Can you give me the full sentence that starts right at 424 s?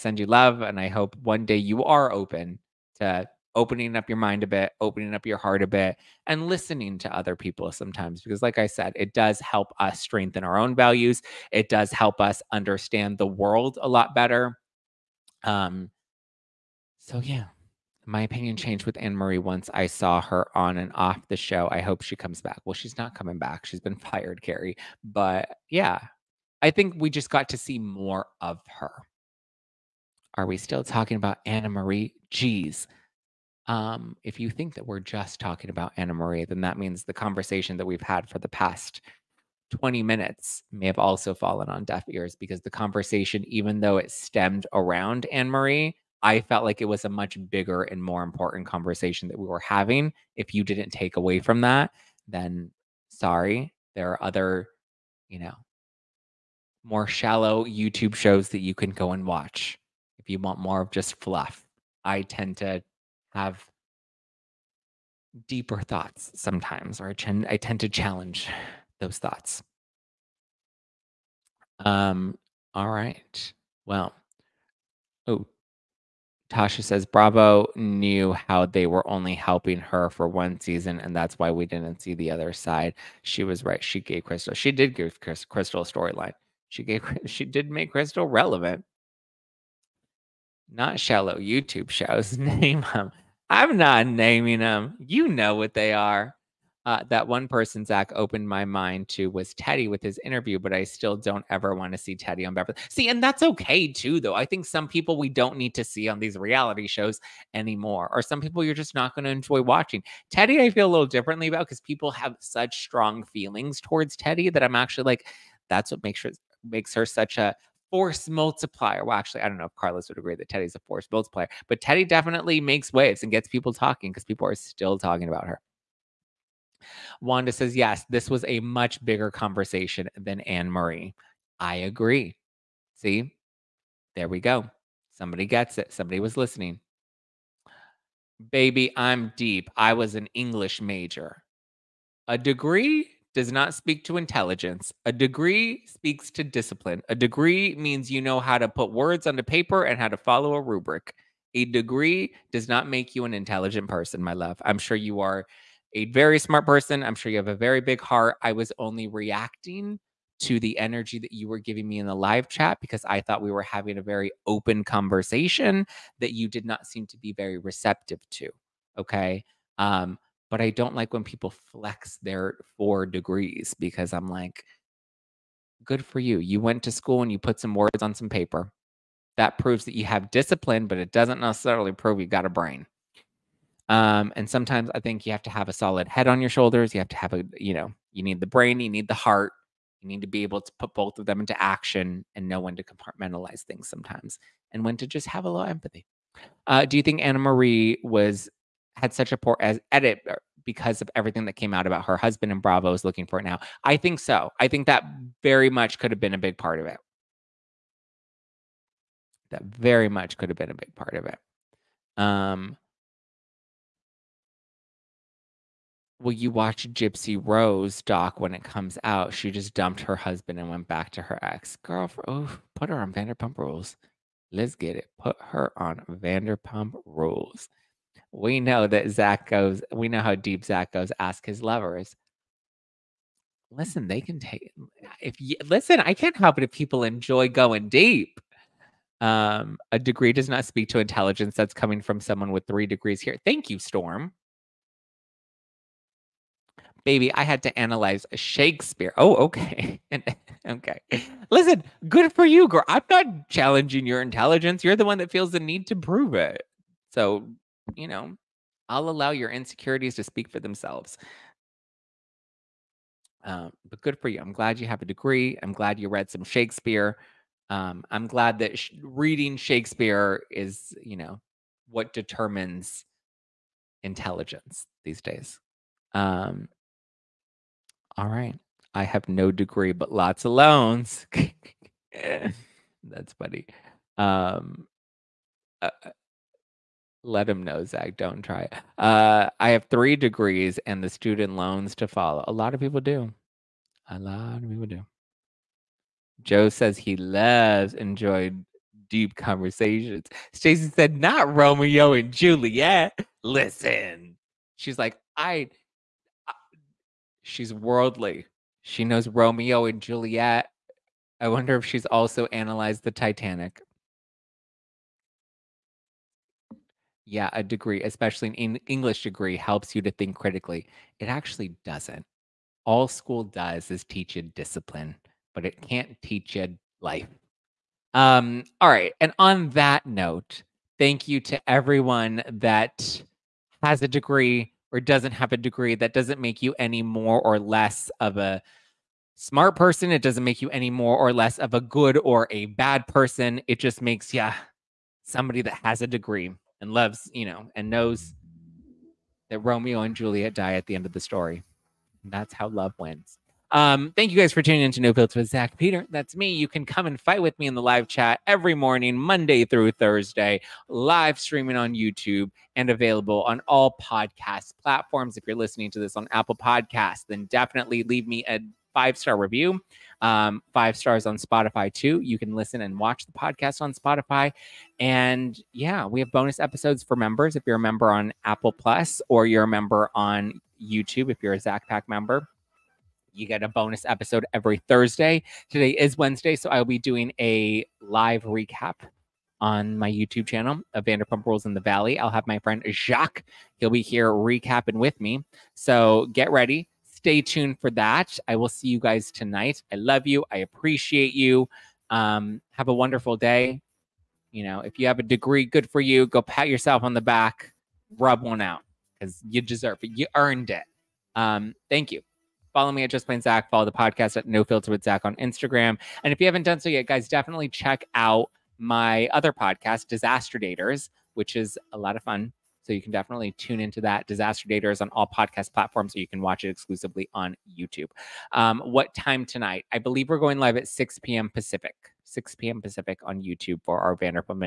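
Disaster Daters on all podcast platforms, so you can watch it exclusively on YouTube.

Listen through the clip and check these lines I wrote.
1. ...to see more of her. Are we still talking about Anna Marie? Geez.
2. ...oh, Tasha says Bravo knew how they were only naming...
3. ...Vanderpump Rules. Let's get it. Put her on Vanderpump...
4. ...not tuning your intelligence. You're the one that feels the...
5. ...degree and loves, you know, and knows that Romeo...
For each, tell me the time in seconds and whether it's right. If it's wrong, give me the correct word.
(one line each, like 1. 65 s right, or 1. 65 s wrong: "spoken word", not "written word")
1. 27 s right
2. 75 s wrong: "helping", not "naming"
3. 223 s right
4. 253 s wrong: "challenging", not "tuning"
5. 346 s right.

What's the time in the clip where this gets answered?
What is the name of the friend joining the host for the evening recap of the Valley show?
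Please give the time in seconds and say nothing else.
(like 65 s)
392 s.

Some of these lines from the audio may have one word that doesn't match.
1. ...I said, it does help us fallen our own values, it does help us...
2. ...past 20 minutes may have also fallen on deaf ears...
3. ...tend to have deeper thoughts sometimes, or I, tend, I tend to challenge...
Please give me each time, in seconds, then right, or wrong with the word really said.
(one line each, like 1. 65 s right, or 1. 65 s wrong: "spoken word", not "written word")
1. 8 s wrong: "strengthen", not "fallen"
2. 38 s right
3. 62 s right.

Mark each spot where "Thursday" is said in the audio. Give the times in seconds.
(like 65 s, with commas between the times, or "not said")
359 s, 384 s.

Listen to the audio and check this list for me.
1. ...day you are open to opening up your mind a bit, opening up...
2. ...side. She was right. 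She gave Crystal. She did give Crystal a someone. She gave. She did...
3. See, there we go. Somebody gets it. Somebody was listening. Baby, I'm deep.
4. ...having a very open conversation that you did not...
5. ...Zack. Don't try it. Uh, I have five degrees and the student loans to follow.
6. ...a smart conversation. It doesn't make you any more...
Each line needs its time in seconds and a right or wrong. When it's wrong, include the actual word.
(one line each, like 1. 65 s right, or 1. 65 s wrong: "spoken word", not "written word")
1. 1 s right
2. 82 s wrong: "storyline", not "someone"
3. 132 s right
4. 163 s right
5. 287 s wrong: "three", not "five"
6. 338 s wrong: "person", not "conversation".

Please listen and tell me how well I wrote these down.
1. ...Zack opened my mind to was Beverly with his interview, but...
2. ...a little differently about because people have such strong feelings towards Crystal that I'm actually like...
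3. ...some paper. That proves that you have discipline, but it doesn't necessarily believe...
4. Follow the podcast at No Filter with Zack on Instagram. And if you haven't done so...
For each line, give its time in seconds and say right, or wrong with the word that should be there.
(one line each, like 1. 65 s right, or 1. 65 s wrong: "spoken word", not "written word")
1. 97 s wrong: "Teddi", not "Beverly"
2. 110 s wrong: "Teddi", not "Crystal"
3. 178 s wrong: "prove", not "believe"
4. 413 s right.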